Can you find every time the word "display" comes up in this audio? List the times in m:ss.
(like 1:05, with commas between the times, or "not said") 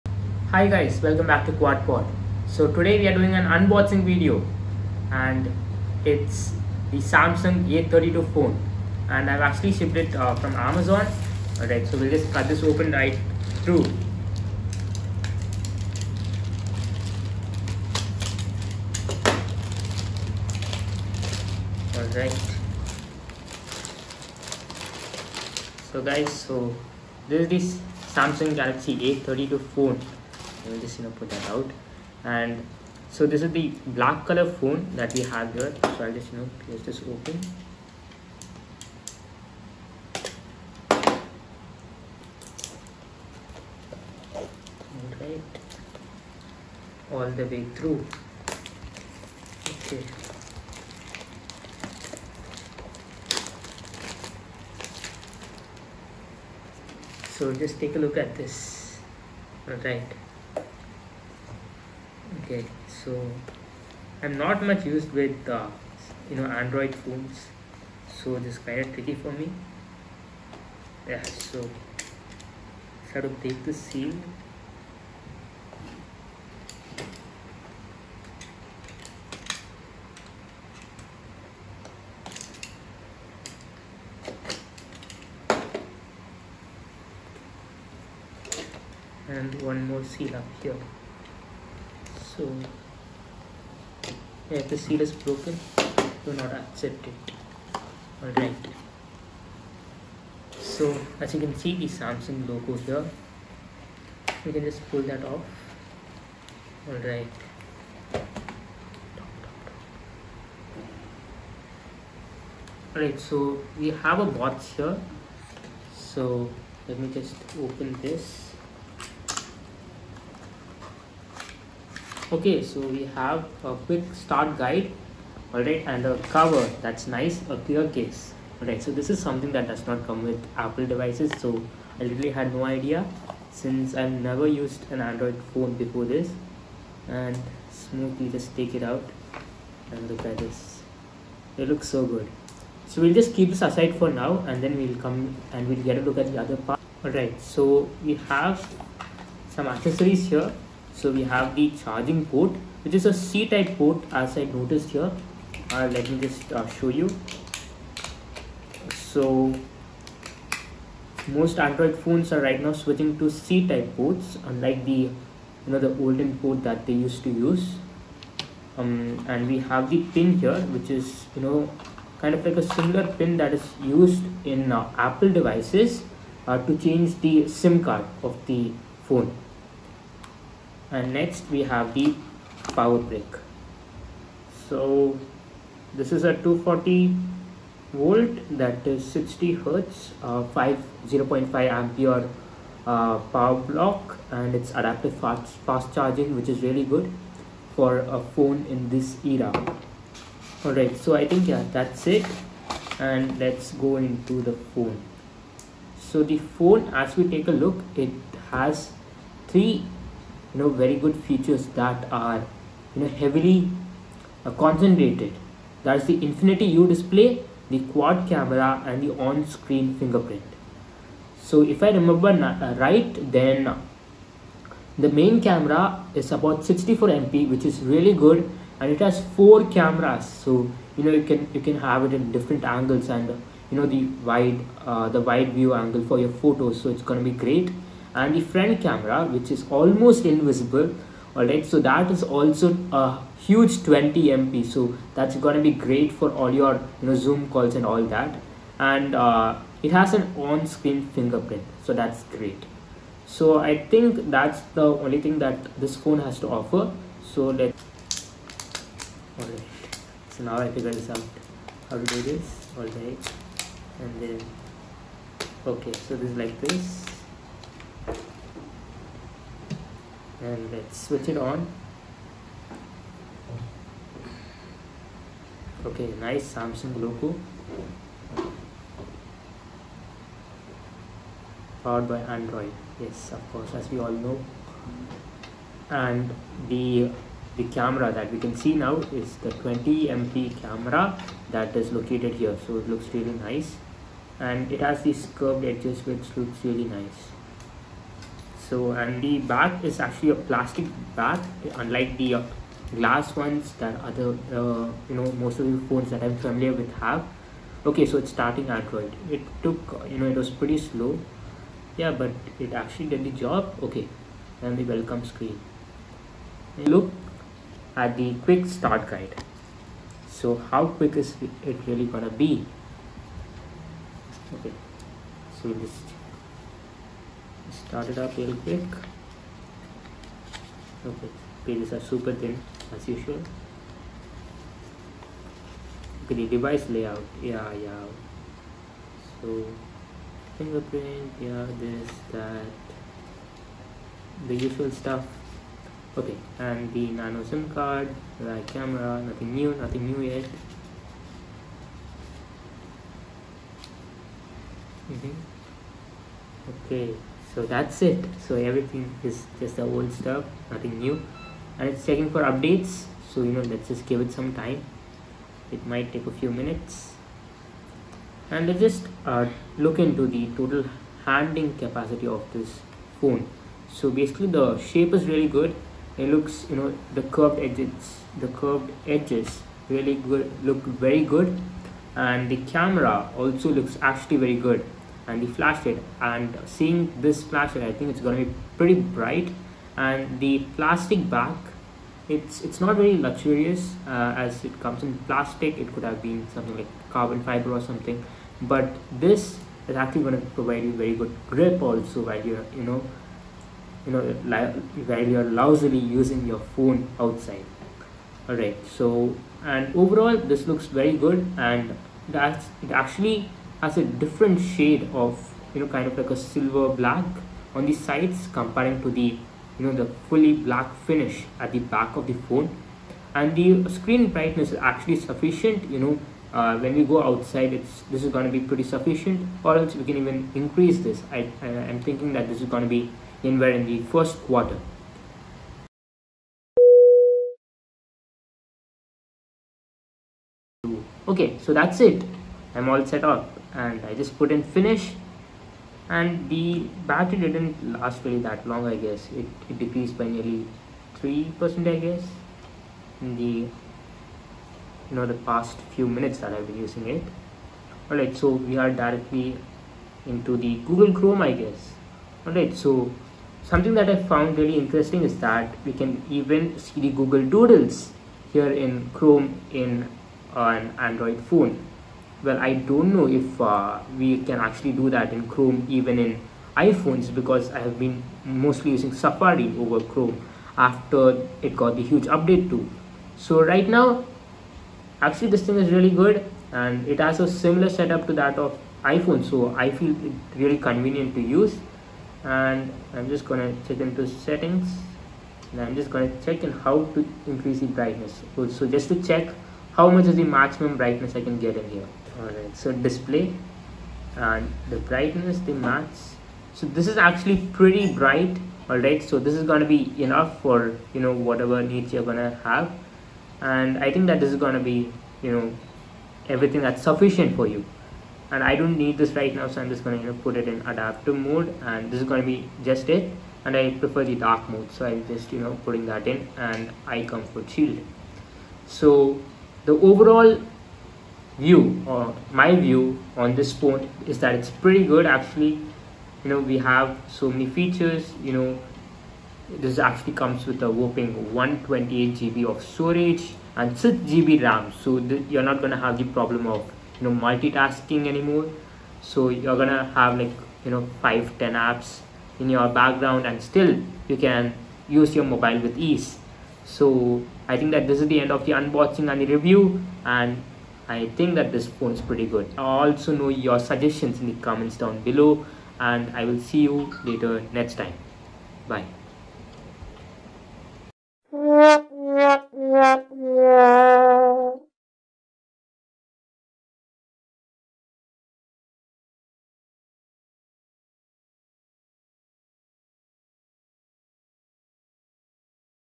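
3:36, 8:22.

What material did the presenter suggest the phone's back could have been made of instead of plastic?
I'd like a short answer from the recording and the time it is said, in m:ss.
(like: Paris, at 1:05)
Carbon fiber, at 6:37.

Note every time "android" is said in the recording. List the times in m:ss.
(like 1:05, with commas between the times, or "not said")
1:06, 2:15, 2:41, 4:42, 5:08, 7:50.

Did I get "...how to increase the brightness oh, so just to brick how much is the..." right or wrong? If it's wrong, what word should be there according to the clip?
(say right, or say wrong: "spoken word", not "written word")
wrong: "check", not "brick".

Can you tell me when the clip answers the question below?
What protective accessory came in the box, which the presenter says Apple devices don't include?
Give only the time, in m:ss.
2:07.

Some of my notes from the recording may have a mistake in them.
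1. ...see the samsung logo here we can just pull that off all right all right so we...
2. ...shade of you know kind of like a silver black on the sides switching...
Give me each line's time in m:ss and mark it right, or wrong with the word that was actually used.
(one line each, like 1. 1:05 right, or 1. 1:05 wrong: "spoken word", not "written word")
1. 1:41 right
2. 6:54 wrong: "comparing", not "switching".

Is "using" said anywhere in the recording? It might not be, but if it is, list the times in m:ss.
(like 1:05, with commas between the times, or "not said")
6:45, 7:36, 7:58.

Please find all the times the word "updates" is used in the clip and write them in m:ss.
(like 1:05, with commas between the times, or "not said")
6:02, 8:02.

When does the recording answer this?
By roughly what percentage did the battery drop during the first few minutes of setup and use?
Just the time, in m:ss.
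7:31.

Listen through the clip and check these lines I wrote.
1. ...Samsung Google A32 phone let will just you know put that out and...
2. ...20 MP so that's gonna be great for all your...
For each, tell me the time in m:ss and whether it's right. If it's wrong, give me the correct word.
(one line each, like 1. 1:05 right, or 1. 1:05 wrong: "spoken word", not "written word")
1. 0:28 wrong: "Galaxy", not "Google"
2. 4:03 right.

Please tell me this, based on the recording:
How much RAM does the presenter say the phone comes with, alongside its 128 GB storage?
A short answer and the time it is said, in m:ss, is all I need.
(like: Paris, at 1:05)
6 GB, at 9:03.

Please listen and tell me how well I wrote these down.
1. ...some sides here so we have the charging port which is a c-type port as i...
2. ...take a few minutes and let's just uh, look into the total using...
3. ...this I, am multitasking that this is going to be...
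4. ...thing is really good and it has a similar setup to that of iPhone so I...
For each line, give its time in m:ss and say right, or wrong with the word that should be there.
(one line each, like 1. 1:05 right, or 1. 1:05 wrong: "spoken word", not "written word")
1. 2:29 wrong: "accessories", not "sides"
2. 6:06 wrong: "handling", not "using"
3. 7:10 wrong: "thinking", not "multitasking"
4. 8:05 right.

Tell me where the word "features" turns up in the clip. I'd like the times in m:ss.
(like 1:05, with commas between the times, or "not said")
3:31, 8:57.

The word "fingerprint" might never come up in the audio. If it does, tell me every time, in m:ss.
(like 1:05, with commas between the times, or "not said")
3:39, 4:11, 5:40.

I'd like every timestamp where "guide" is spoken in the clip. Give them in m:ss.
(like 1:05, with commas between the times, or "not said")
2:04, 5:19.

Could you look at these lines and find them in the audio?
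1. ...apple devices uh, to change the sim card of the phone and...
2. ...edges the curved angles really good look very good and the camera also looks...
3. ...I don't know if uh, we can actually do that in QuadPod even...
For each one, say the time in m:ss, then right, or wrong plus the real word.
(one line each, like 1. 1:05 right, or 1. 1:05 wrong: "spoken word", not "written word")
1. 2:54 right
2. 6:17 wrong: "edges", not "angles"
3. 7:52 wrong: "Chrome", not "QuadPod".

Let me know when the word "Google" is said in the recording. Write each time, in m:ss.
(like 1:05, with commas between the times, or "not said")
7:40, 7:47.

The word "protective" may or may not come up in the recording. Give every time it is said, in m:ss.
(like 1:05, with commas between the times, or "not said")
not said.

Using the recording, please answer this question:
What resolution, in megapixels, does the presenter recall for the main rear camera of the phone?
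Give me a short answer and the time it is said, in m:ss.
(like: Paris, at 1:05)
64 MP, at 3:46.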